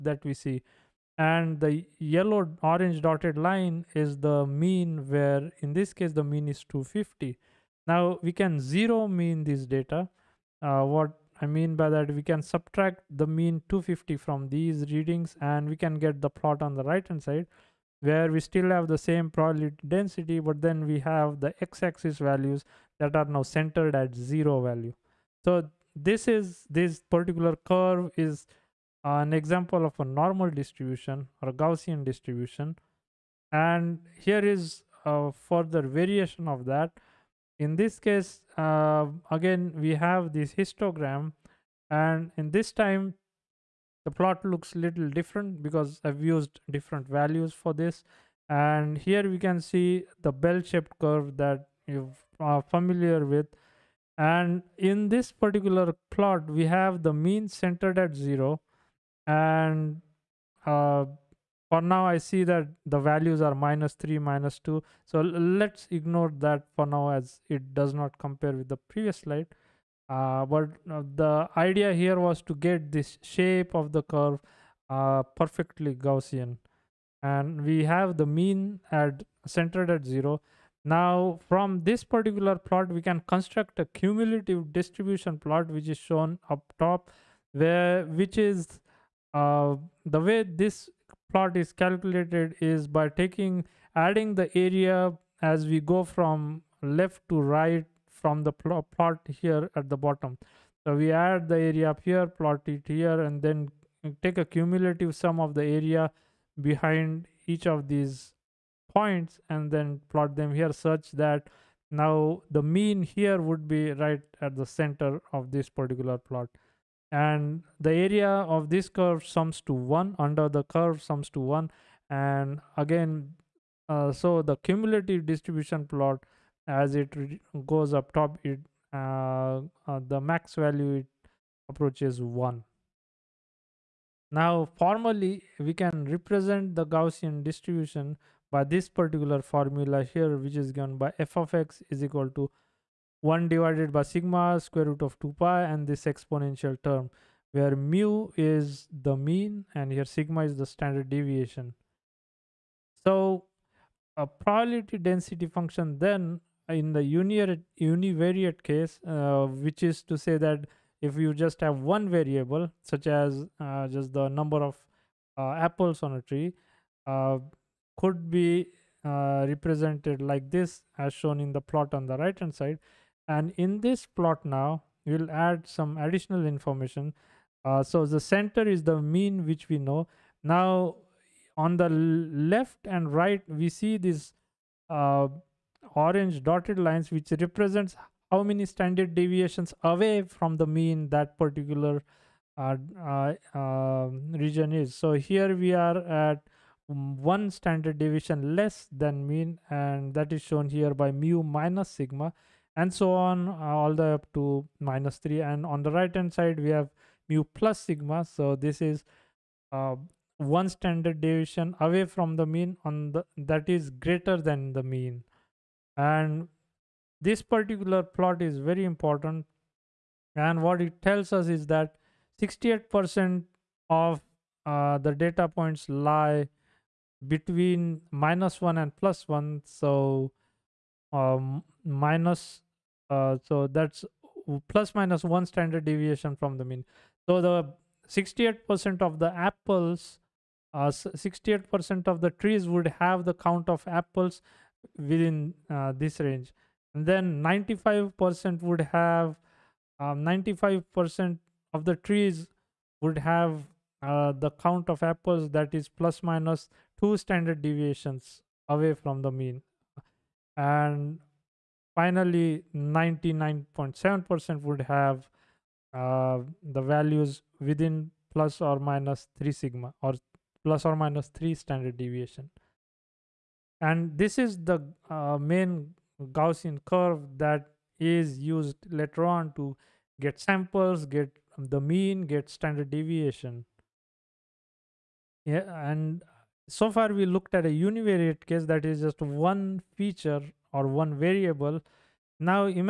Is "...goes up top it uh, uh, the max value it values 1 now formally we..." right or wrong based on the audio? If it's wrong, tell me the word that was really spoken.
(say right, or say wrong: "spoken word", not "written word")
wrong: "approaches", not "values".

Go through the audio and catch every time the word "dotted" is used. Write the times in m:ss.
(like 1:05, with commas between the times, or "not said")
0:03, 3:06.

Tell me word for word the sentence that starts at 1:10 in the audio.
Uh, but uh, the idea here was to get this shape of the curve uh, perfectly Gaussian.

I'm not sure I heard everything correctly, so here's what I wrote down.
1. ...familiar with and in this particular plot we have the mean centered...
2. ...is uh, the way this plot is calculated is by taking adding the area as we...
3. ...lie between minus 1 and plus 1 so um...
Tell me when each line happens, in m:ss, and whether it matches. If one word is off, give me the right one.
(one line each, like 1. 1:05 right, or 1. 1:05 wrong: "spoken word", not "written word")
1. 0:52 right
2. 1:28 right
3. 3:45 right.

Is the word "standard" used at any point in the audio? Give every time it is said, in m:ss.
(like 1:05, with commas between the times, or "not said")
2:30, 3:08, 3:17, 3:30, 3:55, 4:17, 4:31, 4:42.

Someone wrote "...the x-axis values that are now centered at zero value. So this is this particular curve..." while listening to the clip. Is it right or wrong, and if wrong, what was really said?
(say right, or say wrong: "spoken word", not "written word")
right.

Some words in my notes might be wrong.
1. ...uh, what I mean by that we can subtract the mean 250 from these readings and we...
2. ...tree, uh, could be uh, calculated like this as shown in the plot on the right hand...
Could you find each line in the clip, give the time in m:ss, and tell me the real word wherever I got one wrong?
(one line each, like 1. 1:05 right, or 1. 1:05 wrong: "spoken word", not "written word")
1. 0:10 right
2. 2:46 wrong: "represented", not "calculated".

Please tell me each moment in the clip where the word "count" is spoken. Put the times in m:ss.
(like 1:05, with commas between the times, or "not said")
4:03, 4:14.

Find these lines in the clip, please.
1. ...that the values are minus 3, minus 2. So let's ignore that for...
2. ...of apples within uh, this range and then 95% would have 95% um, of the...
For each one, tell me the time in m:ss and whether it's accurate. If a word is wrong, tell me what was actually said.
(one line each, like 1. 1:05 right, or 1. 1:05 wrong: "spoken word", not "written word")
1. 1:02 right
2. 4:03 right.